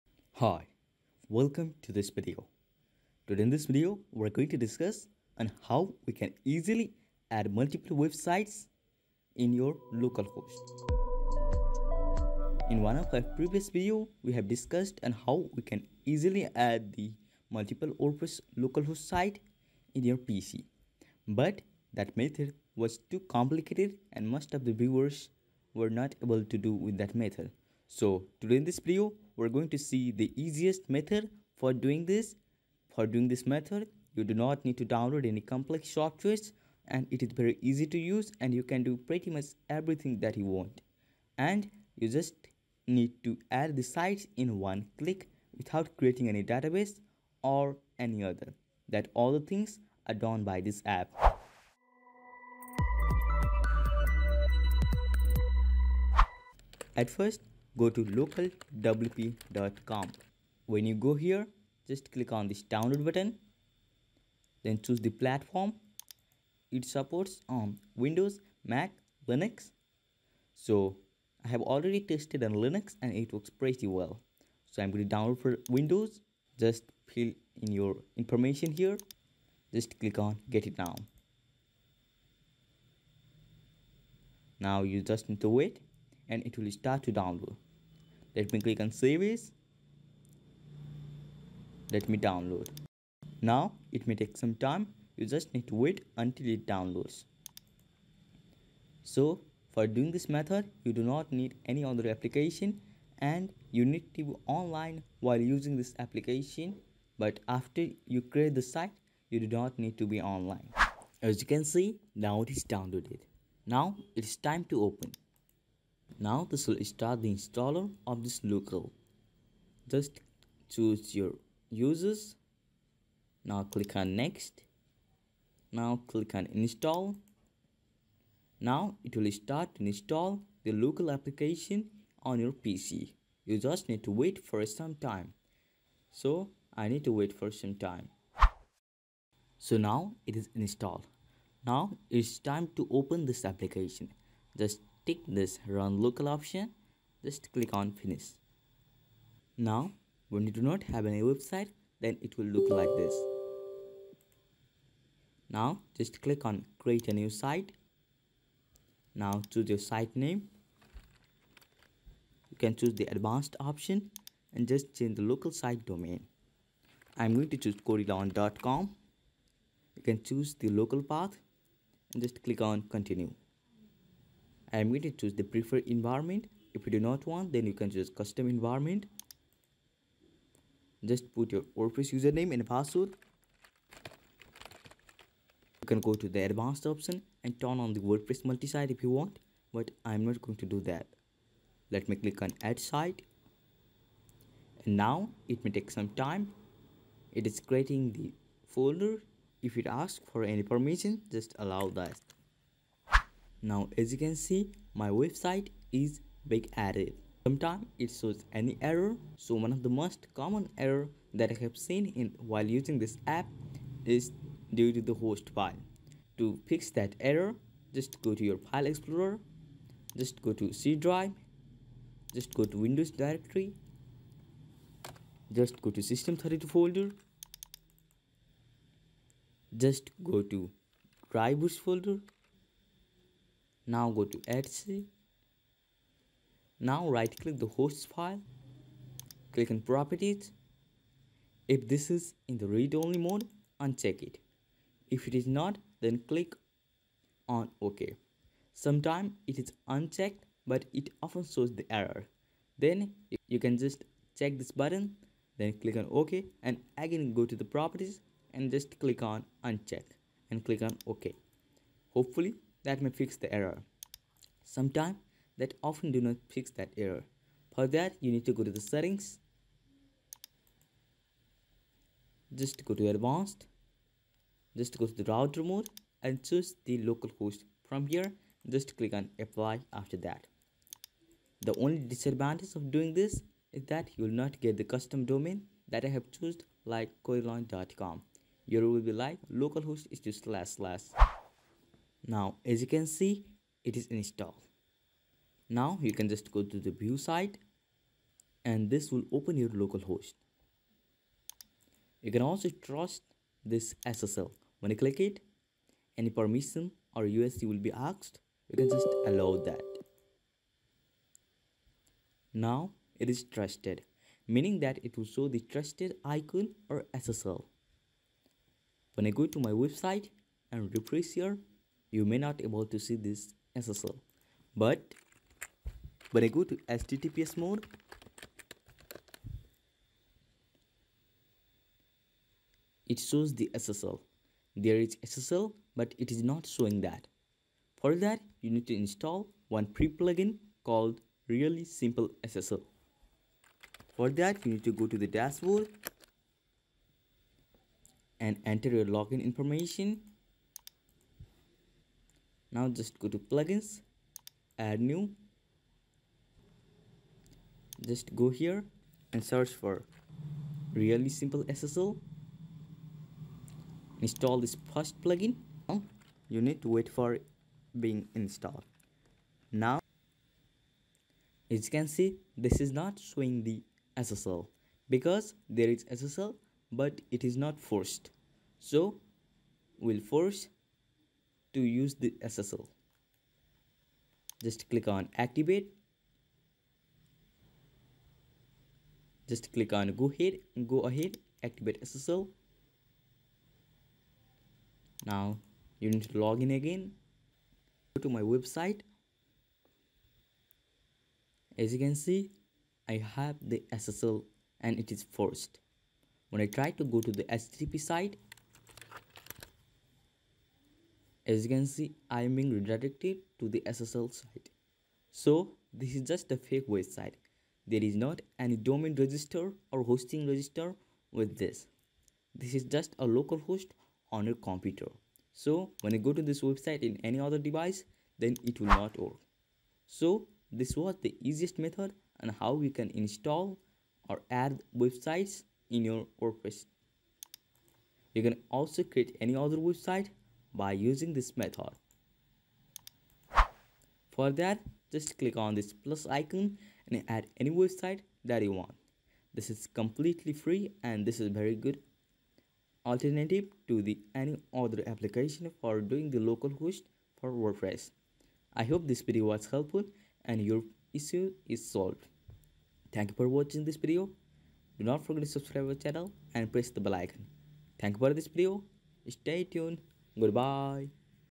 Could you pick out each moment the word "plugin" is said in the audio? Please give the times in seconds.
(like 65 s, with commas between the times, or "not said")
340 s, 353 s, 365 s.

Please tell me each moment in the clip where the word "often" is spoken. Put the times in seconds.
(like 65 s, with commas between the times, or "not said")
251 s, 265 s.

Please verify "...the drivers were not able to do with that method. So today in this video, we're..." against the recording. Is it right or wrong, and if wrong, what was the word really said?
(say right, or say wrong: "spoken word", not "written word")
wrong: "viewers", not "drivers".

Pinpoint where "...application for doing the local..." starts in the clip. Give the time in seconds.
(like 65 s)
455 s.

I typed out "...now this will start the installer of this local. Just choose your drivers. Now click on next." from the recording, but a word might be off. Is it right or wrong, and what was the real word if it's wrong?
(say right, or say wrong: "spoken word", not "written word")
wrong: "users", not "drivers".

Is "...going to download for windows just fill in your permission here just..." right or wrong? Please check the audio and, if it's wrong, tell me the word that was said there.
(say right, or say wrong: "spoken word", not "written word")
wrong: "information", not "permission".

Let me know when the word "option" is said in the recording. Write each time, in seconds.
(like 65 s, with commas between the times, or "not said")
146 s, 163 s, 186 s.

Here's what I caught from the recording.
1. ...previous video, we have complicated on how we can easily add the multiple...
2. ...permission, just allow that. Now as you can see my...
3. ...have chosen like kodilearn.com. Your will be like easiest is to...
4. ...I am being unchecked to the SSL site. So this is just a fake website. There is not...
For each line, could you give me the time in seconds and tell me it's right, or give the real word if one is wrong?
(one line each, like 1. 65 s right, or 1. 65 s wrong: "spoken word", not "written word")
1. 13 s wrong: "discussed", not "complicated"
2. 200 s right
3. 286 s wrong: "localhost", not "easiest"
4. 412 s wrong: "redirected", not "unchecked".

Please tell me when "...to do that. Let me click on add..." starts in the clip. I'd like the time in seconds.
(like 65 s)
190 s.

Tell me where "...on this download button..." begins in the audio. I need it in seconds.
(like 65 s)
62 s.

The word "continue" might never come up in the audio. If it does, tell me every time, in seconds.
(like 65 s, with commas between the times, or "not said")
172 s.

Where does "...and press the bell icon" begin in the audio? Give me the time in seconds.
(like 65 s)
466 s.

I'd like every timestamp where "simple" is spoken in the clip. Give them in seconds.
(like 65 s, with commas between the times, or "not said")
341 s, 361 s.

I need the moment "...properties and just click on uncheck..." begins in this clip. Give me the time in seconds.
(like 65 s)
257 s.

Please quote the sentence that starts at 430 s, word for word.
So this was the easiest method on how you can install or add websites in your WordPress.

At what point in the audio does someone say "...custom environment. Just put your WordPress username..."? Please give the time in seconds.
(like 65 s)
178 s.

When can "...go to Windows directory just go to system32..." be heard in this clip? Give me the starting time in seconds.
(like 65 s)
222 s.